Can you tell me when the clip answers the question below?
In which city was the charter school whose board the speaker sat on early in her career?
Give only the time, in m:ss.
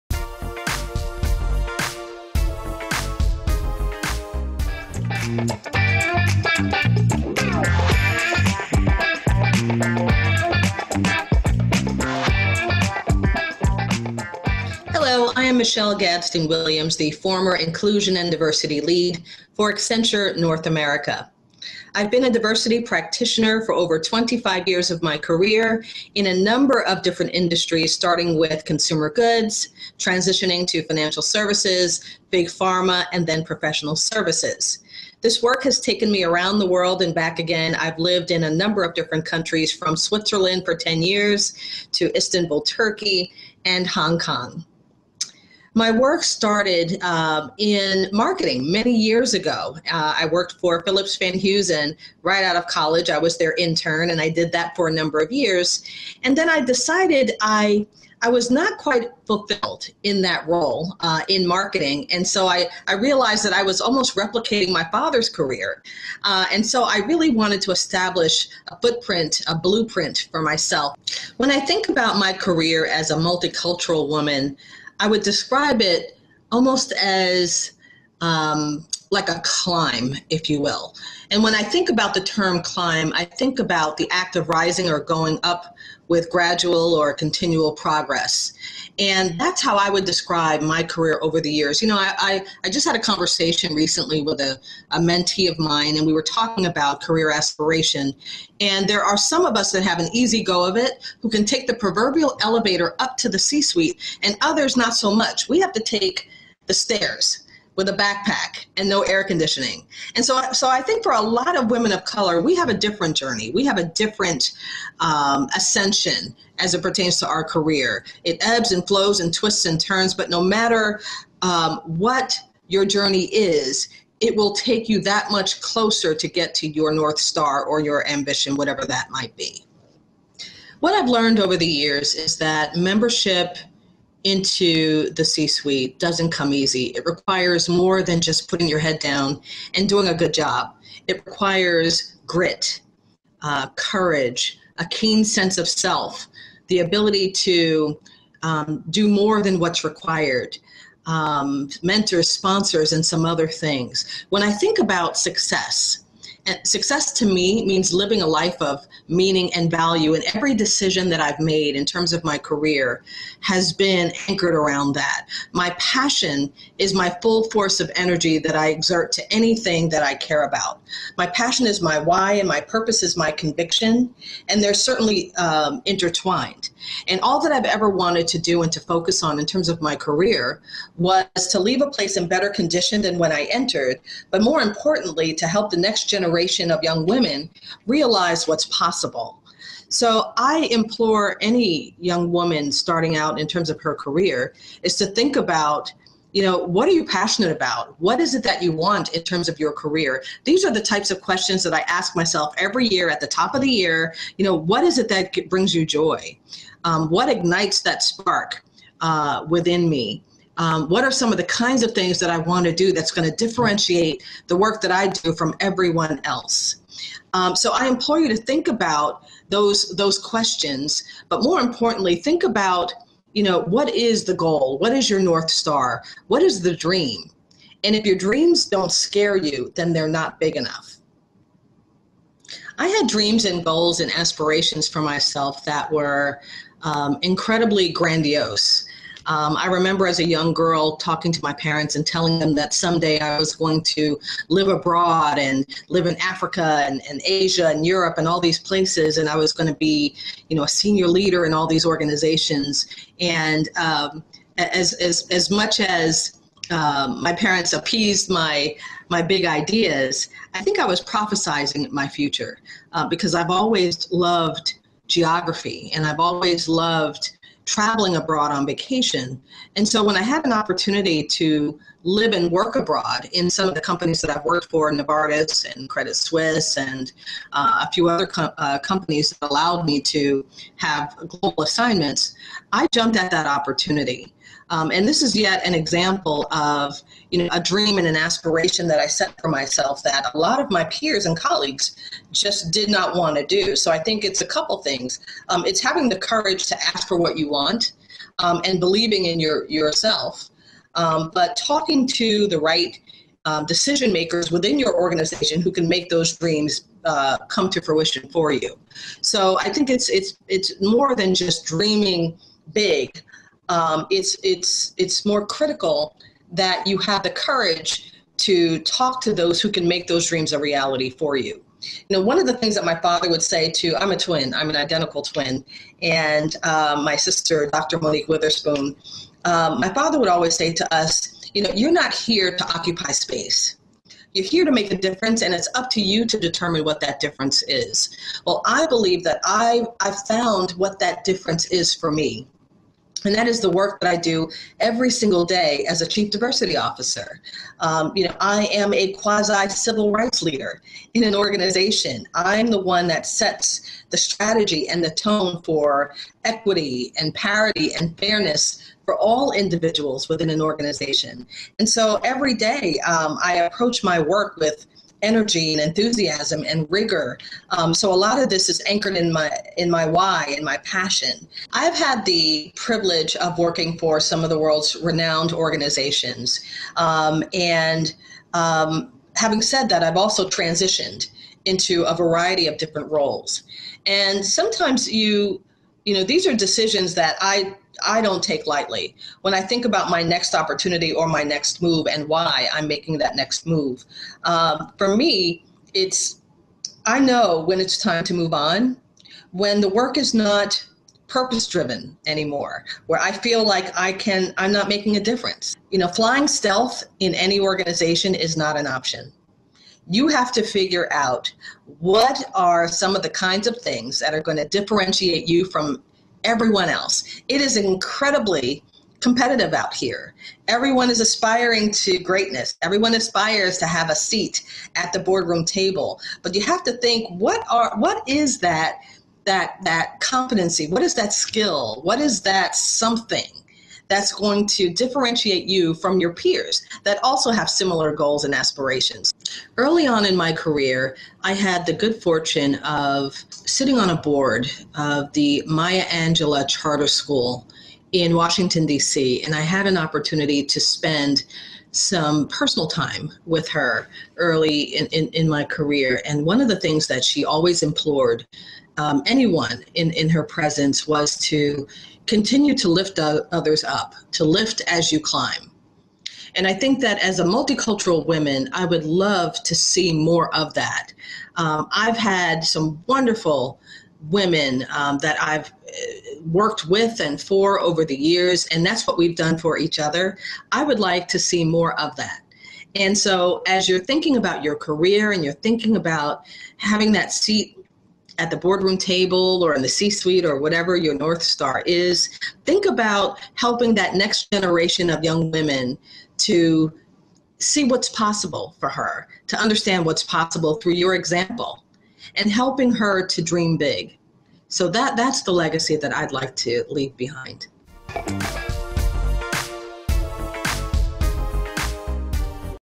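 7:28.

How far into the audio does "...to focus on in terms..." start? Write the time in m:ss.
2:58.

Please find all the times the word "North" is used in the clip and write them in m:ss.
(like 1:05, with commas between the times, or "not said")
0:20, 2:06, 3:45, 8:11.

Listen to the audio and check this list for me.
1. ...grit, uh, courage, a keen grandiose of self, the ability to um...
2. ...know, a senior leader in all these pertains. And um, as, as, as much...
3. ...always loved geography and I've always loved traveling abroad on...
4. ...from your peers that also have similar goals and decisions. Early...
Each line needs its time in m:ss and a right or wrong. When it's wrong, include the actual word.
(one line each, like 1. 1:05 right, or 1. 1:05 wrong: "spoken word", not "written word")
1. 2:22 wrong: "sense", not "grandiose"
2. 4:10 wrong: "organizations", not "pertains"
3. 4:23 right
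4. 7:15 wrong: "aspirations", not "decisions".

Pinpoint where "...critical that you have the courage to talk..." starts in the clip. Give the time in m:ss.
5:15.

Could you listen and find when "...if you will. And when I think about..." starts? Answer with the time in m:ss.
1:20.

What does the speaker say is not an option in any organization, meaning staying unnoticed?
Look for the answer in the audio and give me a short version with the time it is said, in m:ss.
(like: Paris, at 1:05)
flying stealth, at 6:46.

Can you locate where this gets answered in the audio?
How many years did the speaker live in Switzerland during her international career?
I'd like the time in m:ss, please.
0:40.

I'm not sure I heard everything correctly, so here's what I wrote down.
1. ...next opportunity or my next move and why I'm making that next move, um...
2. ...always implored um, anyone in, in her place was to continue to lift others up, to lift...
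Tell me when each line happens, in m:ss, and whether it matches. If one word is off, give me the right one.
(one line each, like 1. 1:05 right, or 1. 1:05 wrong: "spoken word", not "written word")
1. 6:30 right
2. 7:37 wrong: "presence", not "place".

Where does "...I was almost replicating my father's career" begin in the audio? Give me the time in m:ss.
1:03.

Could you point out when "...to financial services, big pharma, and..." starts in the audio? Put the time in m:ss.
0:30.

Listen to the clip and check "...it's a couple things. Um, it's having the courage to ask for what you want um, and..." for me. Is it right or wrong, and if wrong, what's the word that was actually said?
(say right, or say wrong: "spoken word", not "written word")
right.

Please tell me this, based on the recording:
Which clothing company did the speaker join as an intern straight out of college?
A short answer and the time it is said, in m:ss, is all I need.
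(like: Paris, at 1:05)
Phillips Van Heusen, at 0:50.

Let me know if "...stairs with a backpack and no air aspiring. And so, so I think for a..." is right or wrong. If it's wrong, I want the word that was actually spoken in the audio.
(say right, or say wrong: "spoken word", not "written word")
wrong: "conditioning", not "aspiring".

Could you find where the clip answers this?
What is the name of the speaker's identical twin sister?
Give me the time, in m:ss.
5:27.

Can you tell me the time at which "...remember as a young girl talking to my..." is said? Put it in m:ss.
3:59.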